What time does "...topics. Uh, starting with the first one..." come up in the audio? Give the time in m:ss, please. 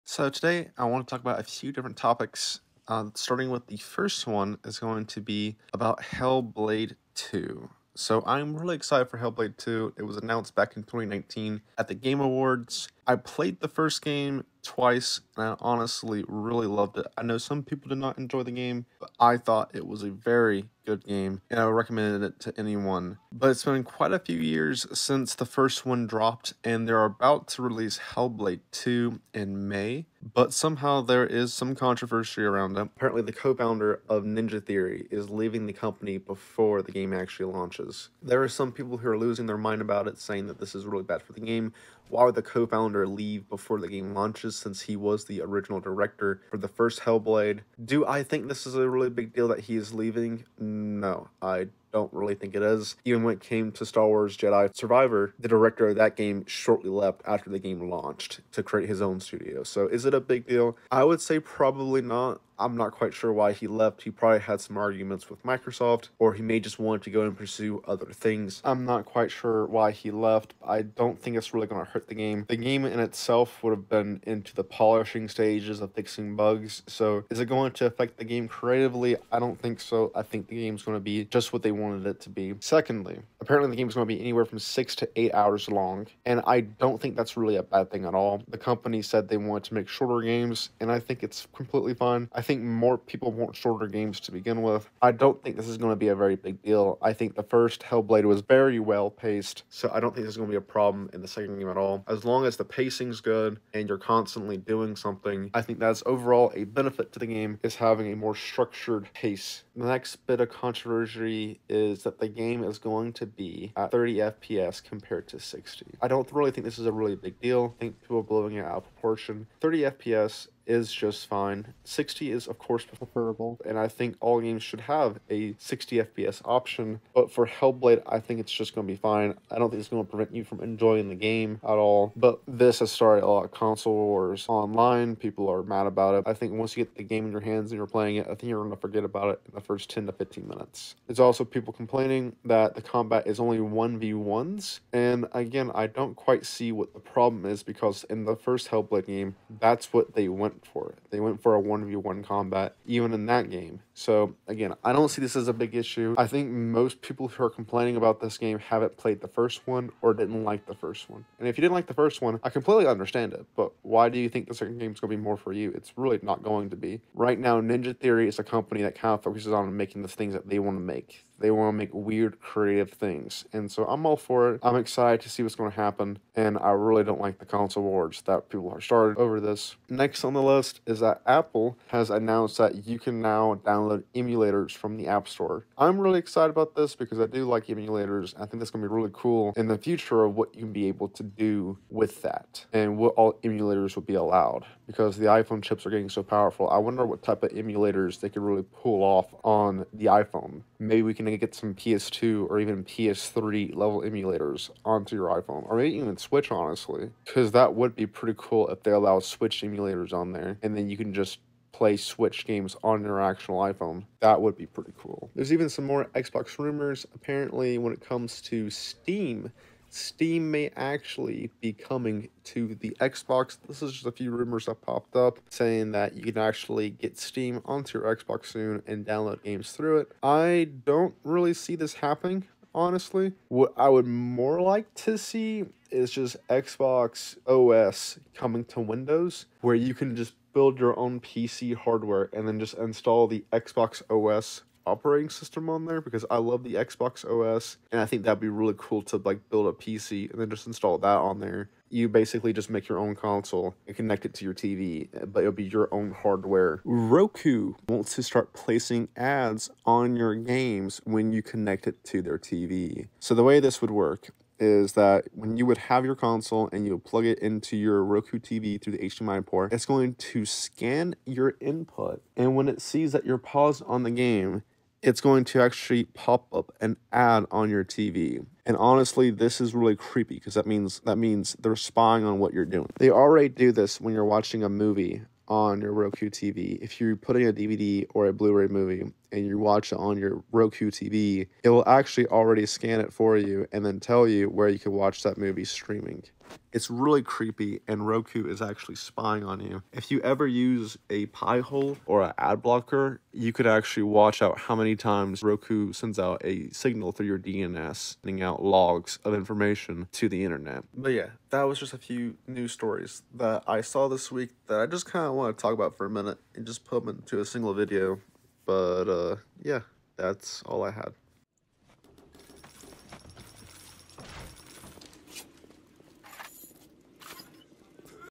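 0:01.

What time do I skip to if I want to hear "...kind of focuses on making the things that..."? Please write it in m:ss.
2:48.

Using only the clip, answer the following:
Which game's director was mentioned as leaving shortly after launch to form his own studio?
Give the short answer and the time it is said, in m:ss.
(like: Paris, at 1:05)
Star Wars Jedi Survivor, at 0:53.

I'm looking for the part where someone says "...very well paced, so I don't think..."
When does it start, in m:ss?
1:38.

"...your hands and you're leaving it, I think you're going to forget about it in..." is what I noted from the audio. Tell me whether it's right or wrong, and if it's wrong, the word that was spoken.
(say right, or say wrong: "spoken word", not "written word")
wrong: "playing", not "leaving".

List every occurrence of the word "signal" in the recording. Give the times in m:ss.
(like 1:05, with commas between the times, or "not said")
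5:06.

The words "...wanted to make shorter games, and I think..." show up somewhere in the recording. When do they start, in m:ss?
1:29.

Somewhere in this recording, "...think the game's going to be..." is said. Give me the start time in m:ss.
1:20.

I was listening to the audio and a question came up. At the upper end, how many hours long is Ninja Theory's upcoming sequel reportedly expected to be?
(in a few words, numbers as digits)
8.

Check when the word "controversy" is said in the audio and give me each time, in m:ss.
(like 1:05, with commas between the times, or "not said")
0:31, 1:50.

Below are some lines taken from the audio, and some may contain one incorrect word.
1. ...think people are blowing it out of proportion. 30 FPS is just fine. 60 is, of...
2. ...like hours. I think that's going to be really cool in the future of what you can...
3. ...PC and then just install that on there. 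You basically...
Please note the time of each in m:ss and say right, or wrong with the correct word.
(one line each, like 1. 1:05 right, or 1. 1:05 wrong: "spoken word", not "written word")
1. 1:57 right
2. 3:07 wrong: "emulators", not "hours"
3. 4:09 right.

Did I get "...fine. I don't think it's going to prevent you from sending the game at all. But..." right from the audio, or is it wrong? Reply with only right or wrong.
wrong.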